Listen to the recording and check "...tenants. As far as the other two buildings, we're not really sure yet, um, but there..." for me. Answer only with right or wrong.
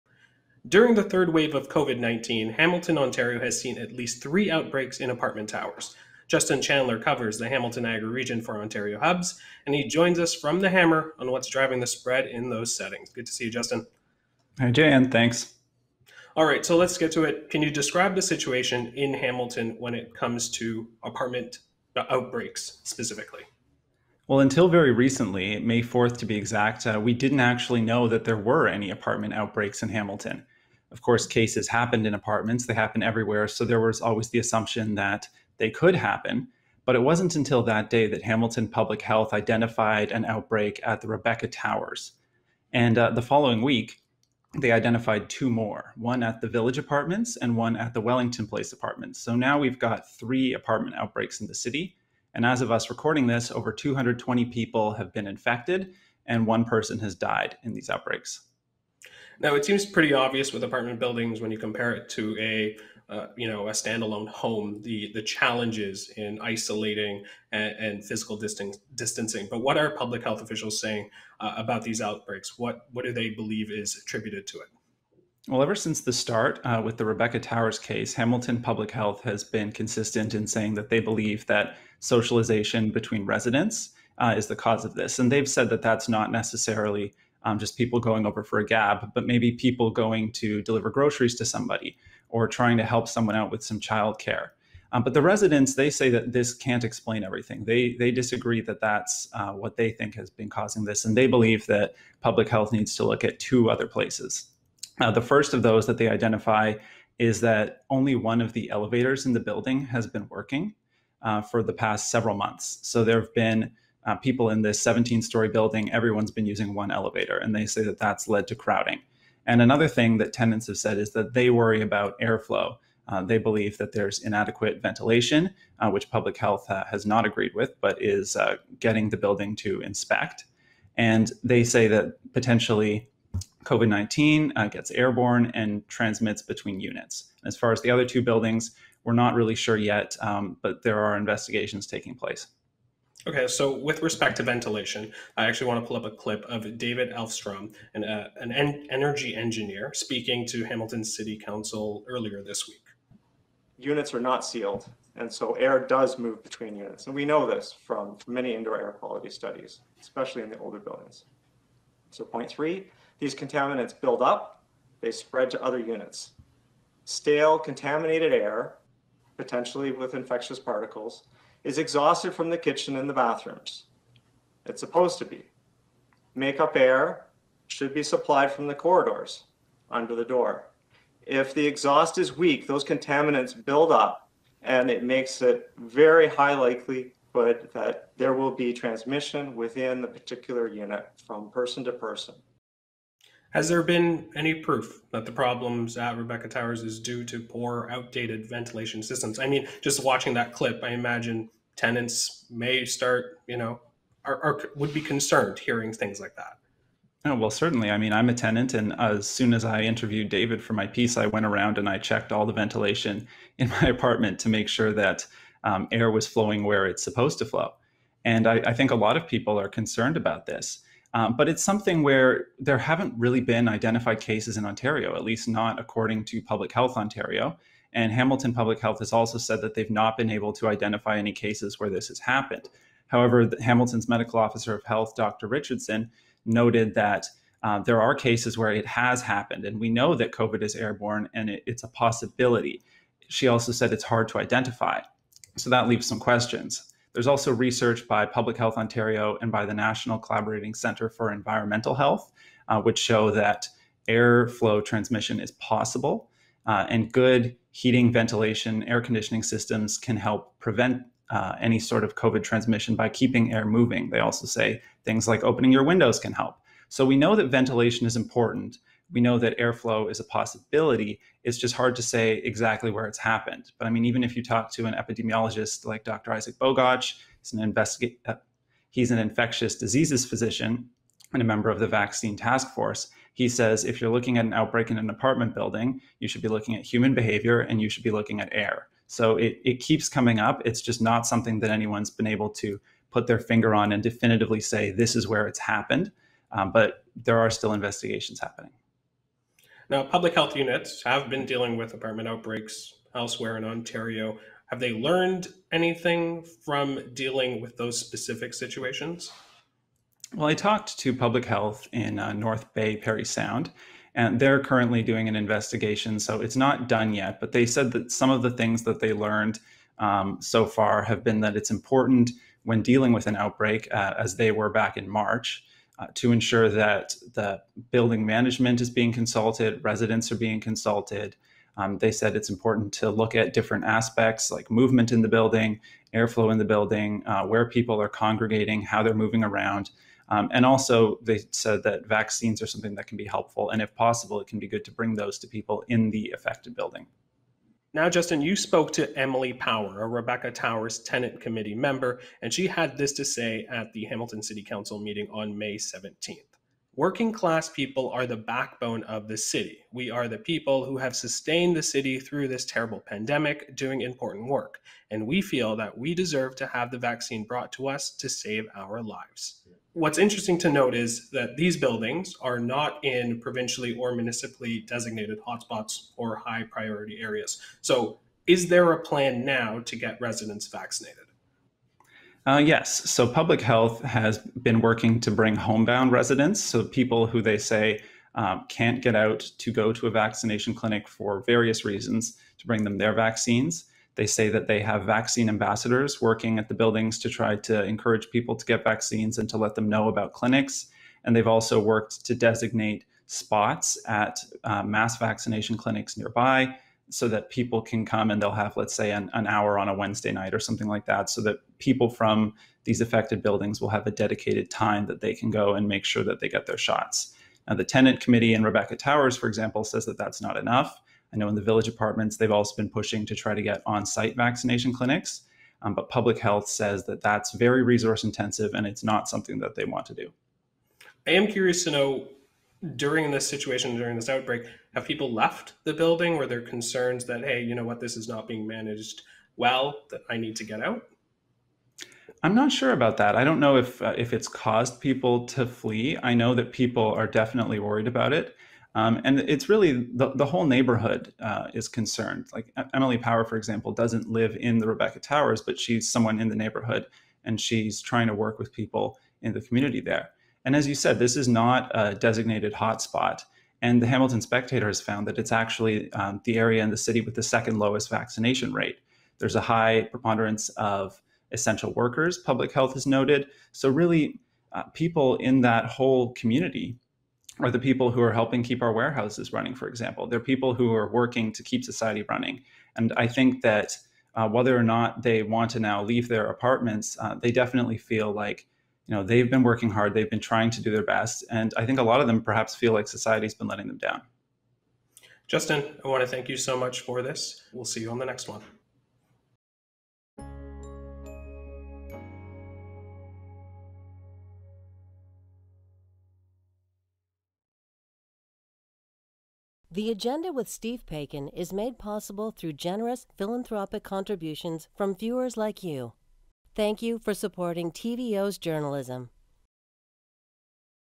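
wrong.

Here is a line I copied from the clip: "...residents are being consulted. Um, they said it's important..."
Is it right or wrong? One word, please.
right.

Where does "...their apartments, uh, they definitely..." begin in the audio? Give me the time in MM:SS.
08:06.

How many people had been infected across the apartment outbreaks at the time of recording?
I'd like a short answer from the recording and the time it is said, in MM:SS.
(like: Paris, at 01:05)
over 220, at 00:53.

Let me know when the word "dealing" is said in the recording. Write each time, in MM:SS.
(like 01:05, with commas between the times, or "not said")
05:01, 05:07, 05:22.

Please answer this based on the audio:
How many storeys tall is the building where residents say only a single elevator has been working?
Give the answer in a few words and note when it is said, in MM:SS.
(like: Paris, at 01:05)
17, at 01:54.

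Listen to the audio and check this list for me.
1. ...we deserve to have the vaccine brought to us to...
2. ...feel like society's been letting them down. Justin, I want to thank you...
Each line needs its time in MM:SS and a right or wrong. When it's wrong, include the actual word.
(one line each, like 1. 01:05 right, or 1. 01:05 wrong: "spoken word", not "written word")
1. 06:05 right
2. 08:12 right.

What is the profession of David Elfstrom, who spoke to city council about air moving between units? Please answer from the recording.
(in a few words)
energy engineer.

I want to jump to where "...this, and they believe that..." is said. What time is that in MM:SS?
01:40.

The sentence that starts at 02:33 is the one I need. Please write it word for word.
Units are not sealed, and so air does move between units.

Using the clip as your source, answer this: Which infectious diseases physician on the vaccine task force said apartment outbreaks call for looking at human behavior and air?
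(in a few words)
Isaac Bogoch.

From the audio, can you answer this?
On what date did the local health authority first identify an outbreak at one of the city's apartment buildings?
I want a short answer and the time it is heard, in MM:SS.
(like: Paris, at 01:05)
May 4, at 00:25.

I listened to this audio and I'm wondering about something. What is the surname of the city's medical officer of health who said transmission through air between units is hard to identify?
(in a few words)
Richardson.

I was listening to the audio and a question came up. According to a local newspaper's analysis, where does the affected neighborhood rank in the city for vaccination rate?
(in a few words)
second lowest.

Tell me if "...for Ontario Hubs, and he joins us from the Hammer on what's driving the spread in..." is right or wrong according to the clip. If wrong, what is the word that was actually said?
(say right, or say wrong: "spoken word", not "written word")
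right.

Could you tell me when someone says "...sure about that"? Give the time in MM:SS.
07:22.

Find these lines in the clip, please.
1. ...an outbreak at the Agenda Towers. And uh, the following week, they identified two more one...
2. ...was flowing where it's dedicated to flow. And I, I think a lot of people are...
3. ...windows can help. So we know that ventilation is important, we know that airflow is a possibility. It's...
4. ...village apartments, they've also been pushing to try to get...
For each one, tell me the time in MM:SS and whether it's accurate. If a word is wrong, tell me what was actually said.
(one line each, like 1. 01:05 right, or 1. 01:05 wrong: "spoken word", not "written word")
1. 00:40 wrong: "Rebecca", not "Agenda"
2. 03:36 wrong: "supposed", not "dedicated"
3. 04:25 right
4. 07:01 right.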